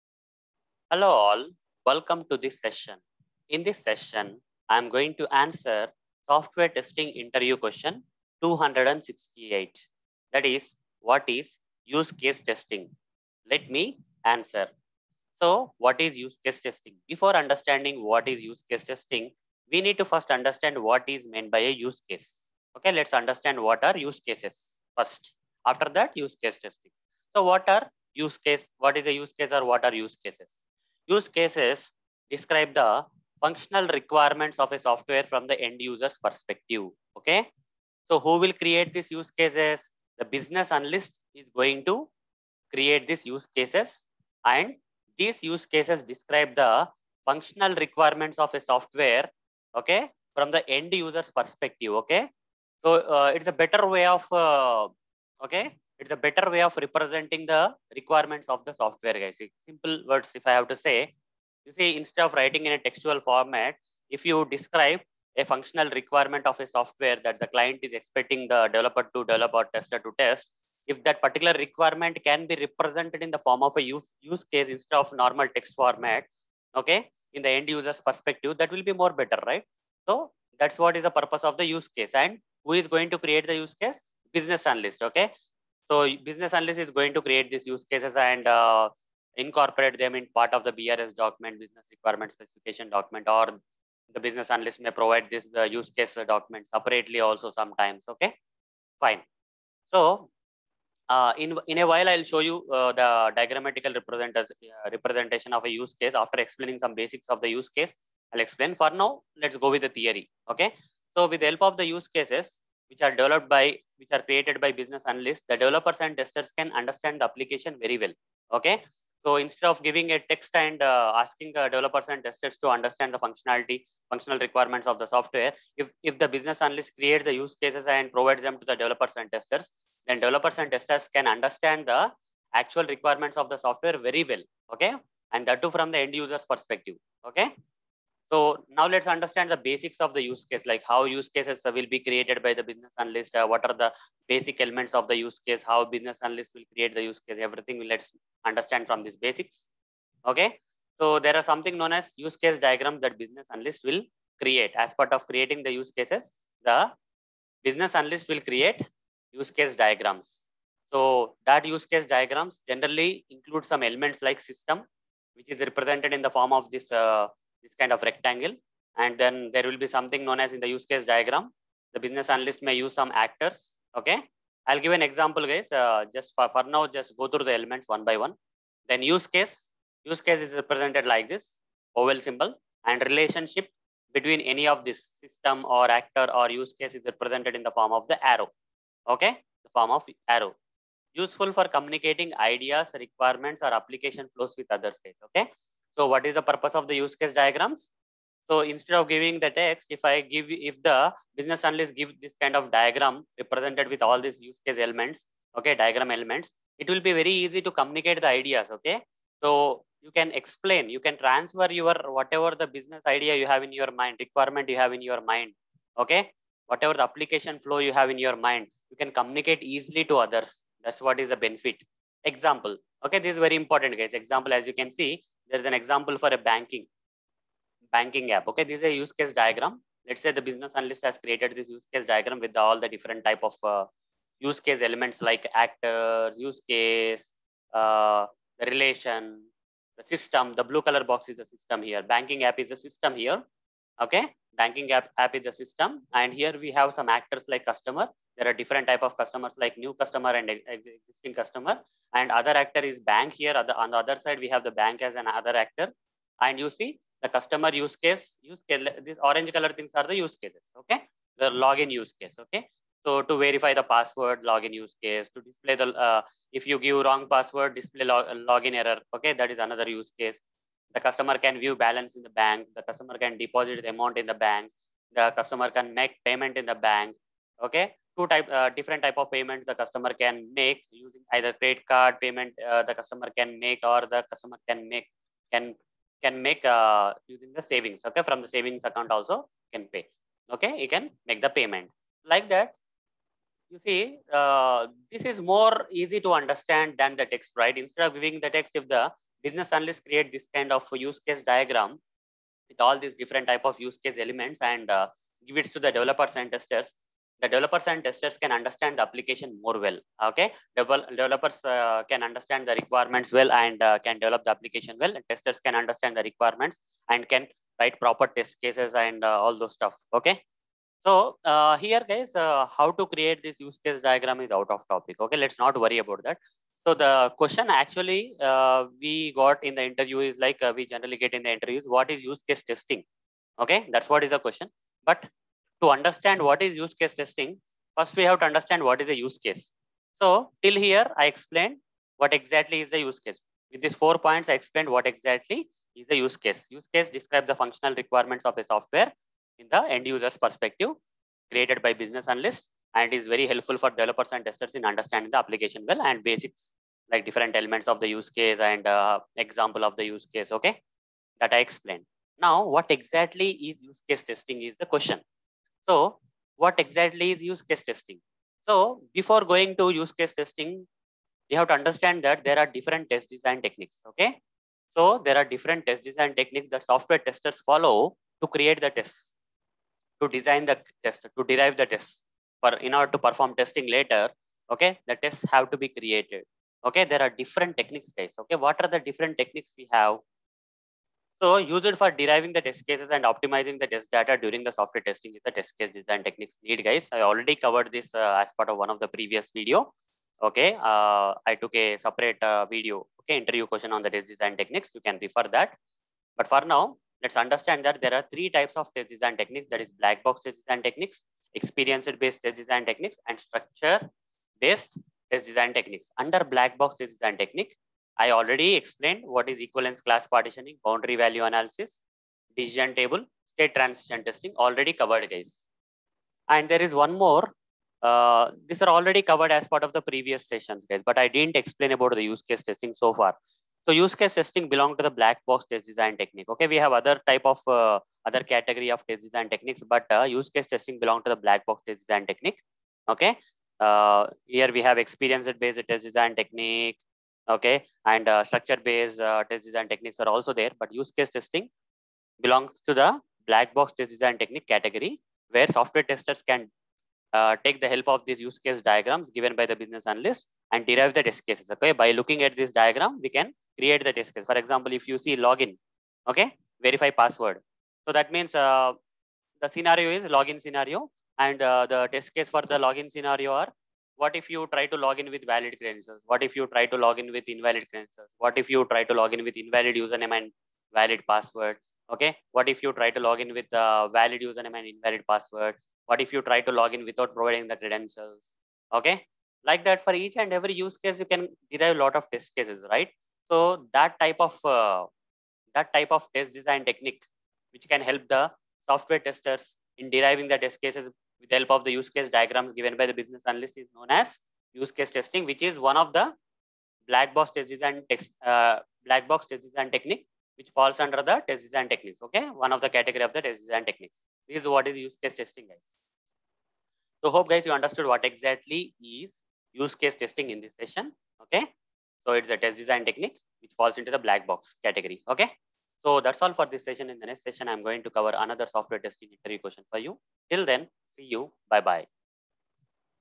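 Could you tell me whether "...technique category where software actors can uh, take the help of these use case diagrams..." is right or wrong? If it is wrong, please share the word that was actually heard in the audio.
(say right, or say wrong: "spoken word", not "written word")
wrong: "testers", not "actors".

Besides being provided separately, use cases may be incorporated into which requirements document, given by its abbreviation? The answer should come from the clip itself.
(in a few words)
BRS.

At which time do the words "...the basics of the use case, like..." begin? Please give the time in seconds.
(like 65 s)
139 s.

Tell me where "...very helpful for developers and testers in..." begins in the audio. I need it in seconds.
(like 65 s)
353 s.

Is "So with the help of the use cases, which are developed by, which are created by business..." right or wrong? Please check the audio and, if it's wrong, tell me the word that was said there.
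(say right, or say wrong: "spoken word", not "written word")
right.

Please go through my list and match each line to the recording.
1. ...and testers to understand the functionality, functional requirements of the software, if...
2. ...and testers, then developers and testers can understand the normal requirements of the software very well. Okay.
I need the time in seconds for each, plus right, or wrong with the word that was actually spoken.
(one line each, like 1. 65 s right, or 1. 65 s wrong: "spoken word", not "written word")
1. 122 s right
2. 129 s wrong: "actual", not "normal".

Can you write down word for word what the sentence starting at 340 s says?
So till here, I explained what exactly is a use case.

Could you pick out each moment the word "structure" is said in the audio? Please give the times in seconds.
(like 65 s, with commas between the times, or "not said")
413 s, 448 s.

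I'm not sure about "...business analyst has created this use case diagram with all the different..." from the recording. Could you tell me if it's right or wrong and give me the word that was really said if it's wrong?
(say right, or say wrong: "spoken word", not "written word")
right.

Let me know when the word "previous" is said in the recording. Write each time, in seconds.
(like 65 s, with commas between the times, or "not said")
399 s, 430 s.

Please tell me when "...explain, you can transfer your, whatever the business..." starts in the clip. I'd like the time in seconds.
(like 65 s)
210 s.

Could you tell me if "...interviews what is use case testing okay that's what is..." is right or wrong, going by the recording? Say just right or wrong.
right.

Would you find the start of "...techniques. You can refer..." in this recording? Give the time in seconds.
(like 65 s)
404 s.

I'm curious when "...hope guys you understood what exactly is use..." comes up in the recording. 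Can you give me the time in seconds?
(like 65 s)
517 s.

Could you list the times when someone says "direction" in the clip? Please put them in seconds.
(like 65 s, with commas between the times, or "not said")
not said.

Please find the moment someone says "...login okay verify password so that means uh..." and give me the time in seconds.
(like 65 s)
465 s.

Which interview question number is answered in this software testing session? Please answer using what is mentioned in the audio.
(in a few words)
268.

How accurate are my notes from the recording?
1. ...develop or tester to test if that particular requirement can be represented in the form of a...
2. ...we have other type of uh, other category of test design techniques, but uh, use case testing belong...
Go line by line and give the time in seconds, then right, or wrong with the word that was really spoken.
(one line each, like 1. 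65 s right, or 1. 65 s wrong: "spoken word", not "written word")
1. 69 s right
2. 436 s right.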